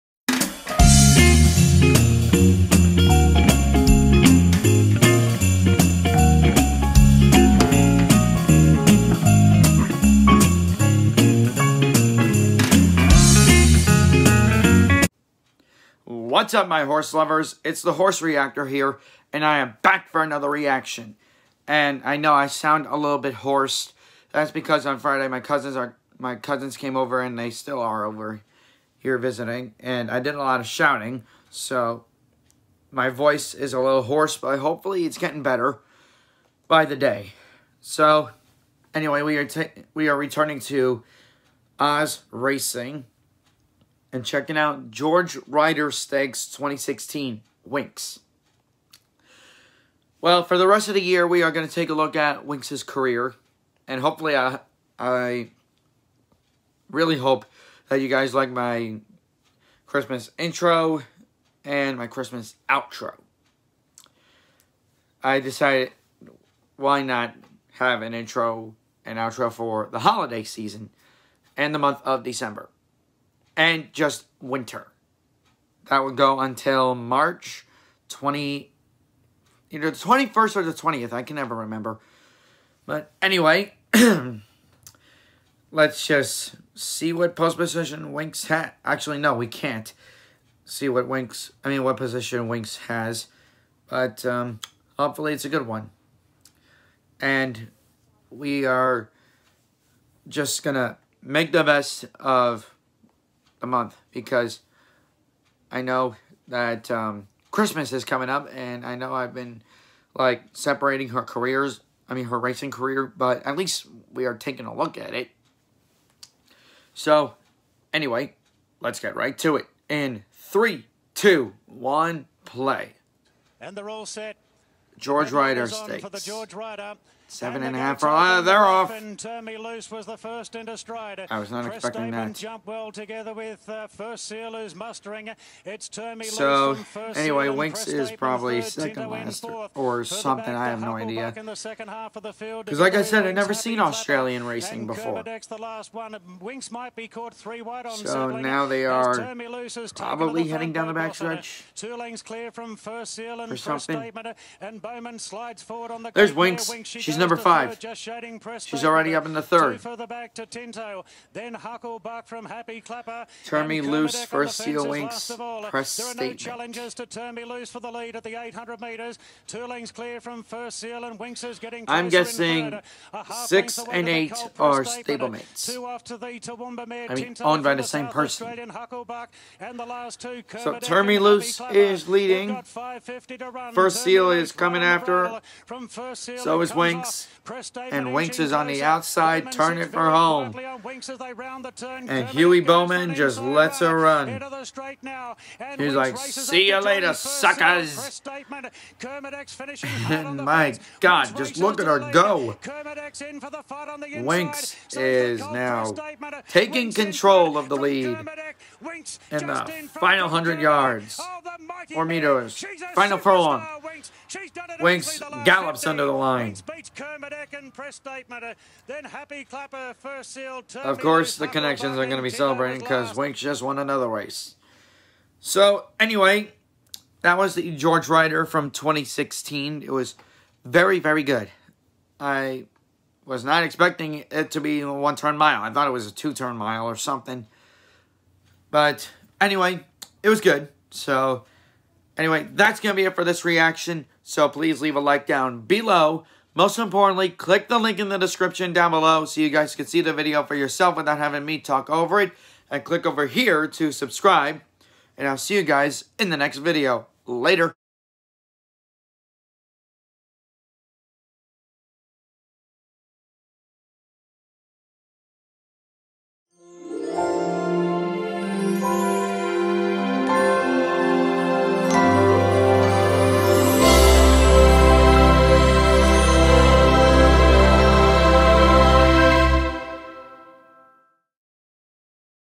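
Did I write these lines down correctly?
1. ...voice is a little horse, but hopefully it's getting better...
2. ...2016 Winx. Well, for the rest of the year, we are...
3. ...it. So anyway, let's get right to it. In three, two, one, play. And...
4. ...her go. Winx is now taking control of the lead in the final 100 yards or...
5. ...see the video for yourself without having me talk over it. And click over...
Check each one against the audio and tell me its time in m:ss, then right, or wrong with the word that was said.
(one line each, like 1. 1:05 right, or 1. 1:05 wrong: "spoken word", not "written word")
1. 0:33 wrong: "hoarse", not "horse"
2. 0:46 right
3. 1:55 right
4. 3:21 right
5. 4:09 right.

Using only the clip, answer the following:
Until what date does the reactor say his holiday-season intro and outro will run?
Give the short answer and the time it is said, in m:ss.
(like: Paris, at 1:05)
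March 20, at 1:16.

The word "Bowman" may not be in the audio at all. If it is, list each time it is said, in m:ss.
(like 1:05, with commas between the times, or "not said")
2:34, 3:12.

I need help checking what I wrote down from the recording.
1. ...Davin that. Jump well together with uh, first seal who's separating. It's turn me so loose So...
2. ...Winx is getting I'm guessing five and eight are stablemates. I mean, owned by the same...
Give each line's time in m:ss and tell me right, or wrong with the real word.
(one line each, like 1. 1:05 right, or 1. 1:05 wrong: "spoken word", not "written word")
1. 2:12 wrong: "mustering", not "separating"
2. 2:51 wrong: "six", not "five".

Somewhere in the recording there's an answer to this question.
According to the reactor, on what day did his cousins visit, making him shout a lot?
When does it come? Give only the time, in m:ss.
0:24.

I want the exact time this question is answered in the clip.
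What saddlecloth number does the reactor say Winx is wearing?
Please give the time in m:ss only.
2:37.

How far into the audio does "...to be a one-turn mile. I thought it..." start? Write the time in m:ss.
3:54.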